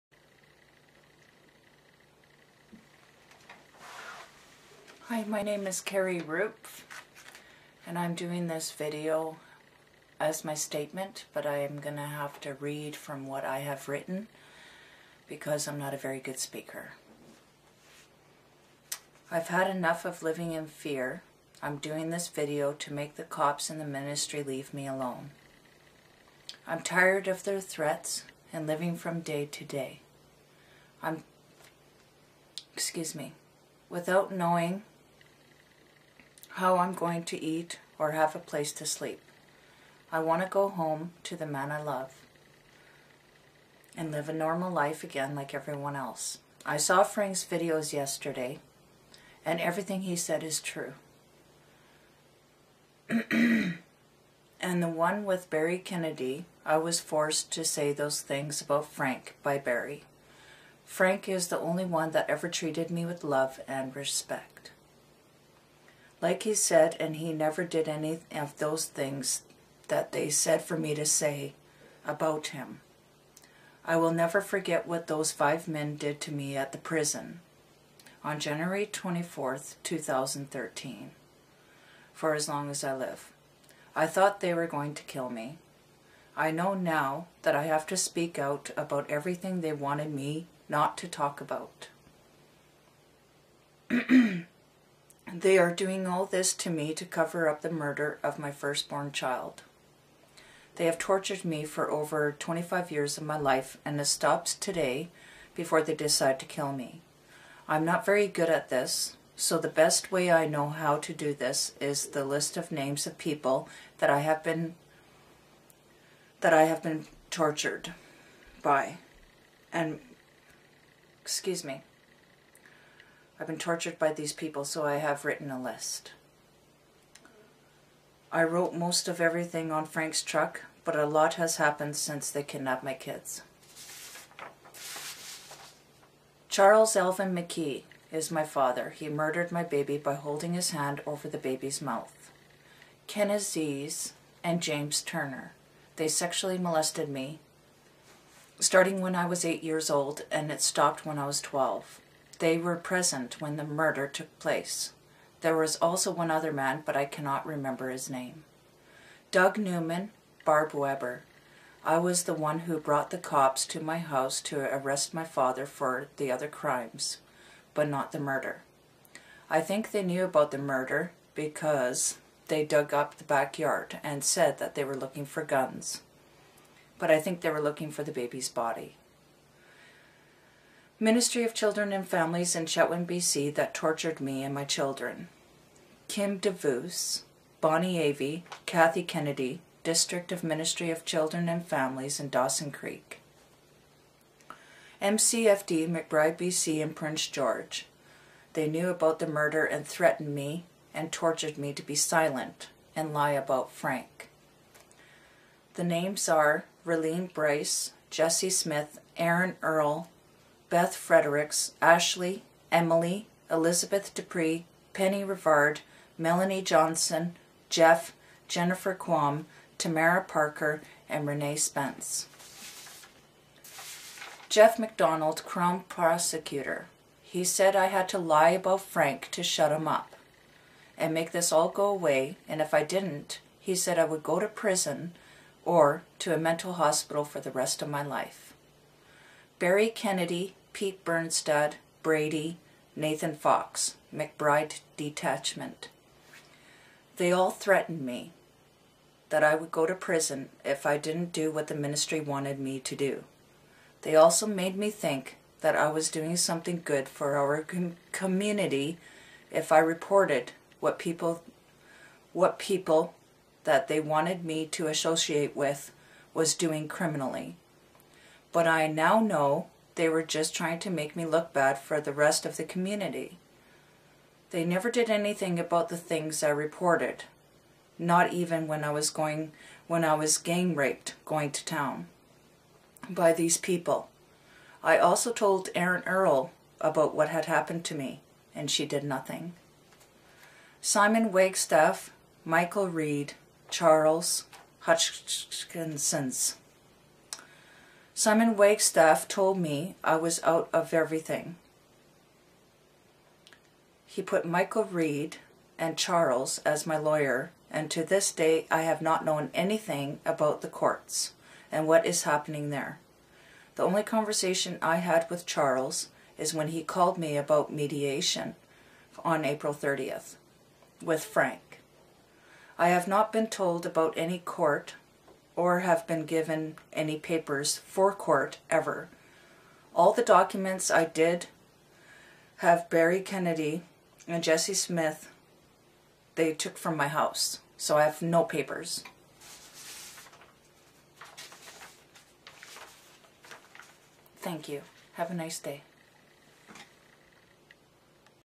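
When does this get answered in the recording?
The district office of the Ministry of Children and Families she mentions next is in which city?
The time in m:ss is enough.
3:12.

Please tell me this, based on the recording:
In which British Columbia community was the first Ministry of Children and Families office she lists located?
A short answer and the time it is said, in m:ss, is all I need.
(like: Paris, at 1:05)
Chetwynd, at 3:02.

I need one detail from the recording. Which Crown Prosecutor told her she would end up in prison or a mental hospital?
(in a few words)
Jeff McDonald.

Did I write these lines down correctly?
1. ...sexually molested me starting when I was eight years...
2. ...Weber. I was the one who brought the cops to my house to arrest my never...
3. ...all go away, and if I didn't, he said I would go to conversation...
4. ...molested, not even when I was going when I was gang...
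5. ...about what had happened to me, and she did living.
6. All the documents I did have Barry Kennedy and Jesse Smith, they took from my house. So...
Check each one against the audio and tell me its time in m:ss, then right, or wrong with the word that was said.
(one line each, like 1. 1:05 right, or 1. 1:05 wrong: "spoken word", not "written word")
1. 2:26 right
2. 2:40 wrong: "father", not "never"
3. 3:51 wrong: "prison", not "conversation"
4. 4:36 wrong: "reported", not "molested"
5. 4:46 wrong: "nothing", not "living"
6. 5:29 right.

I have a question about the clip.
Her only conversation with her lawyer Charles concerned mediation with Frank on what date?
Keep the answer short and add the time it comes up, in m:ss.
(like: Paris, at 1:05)
April 30, at 5:19.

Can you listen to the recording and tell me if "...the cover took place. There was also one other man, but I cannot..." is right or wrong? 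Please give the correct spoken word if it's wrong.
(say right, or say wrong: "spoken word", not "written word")
wrong: "murder", not "cover".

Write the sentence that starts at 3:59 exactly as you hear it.
Barry Kennedy, Pete Bernstad, Brady, Nathan Fox, McBride Detachment.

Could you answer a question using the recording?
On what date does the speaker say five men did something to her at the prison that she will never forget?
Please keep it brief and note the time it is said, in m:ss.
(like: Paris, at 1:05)
January 24, 2013, at 1:18.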